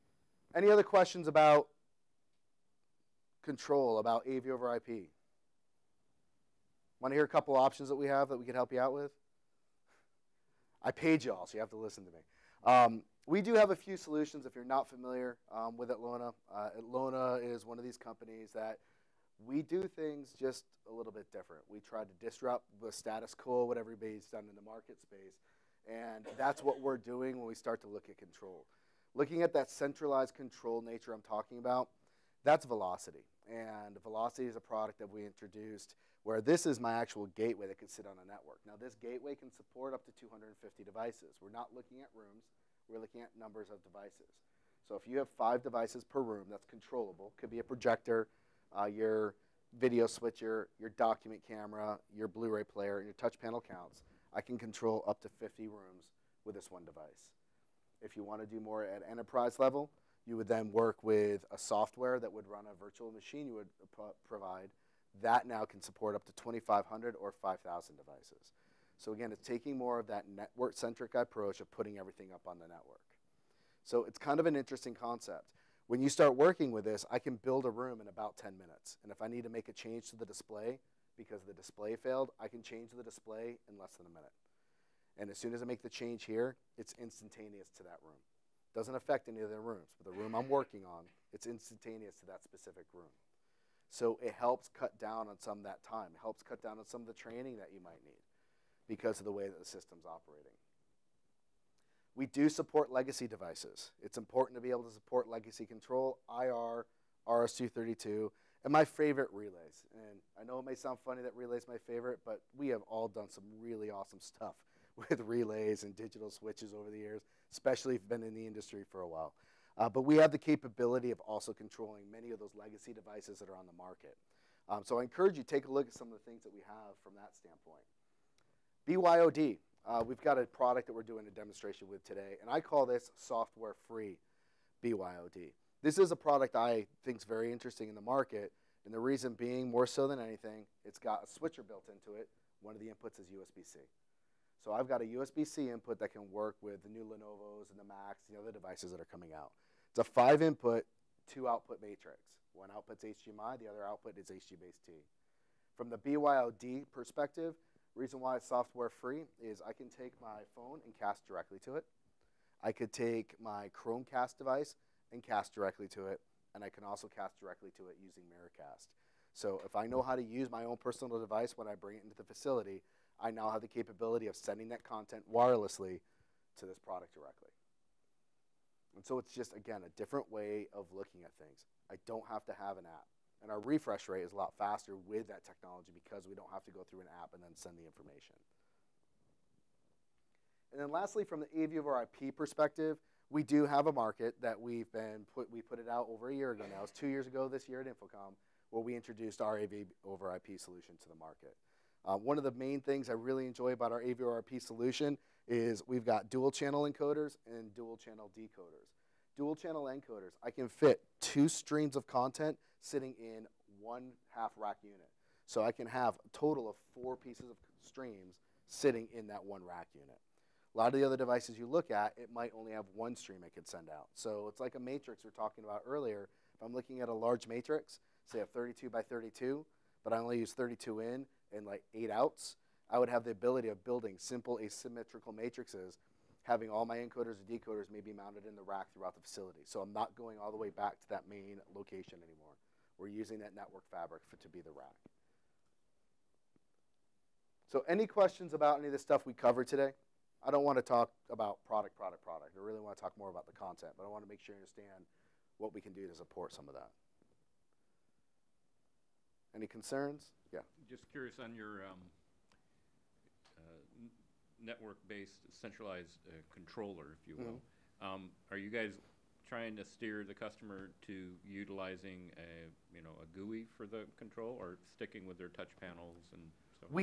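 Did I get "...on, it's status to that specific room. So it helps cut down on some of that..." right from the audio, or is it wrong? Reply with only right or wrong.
wrong.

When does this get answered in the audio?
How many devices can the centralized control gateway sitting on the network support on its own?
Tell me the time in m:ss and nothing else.
0:40.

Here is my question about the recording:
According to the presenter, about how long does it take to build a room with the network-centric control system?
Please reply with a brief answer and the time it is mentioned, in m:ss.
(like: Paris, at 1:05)
10 minutes, at 1:18.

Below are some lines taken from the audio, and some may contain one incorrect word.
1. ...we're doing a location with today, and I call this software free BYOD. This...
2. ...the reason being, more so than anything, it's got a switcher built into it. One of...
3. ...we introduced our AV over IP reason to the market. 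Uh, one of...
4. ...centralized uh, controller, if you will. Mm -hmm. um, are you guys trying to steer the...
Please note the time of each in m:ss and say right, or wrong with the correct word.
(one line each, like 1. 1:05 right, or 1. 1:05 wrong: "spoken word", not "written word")
1. 2:10 wrong: "demonstration", not "location"
2. 2:18 right
3. 3:18 wrong: "solution", not "reason"
4. 4:25 right.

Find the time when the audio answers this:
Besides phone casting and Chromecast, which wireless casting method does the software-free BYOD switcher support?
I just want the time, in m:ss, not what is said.
2:48.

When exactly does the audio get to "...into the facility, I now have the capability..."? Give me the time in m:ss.
2:52.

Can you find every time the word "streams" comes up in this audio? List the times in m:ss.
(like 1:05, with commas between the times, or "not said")
3:31, 3:37, 3:43.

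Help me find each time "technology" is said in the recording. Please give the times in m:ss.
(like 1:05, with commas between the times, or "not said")
3:05.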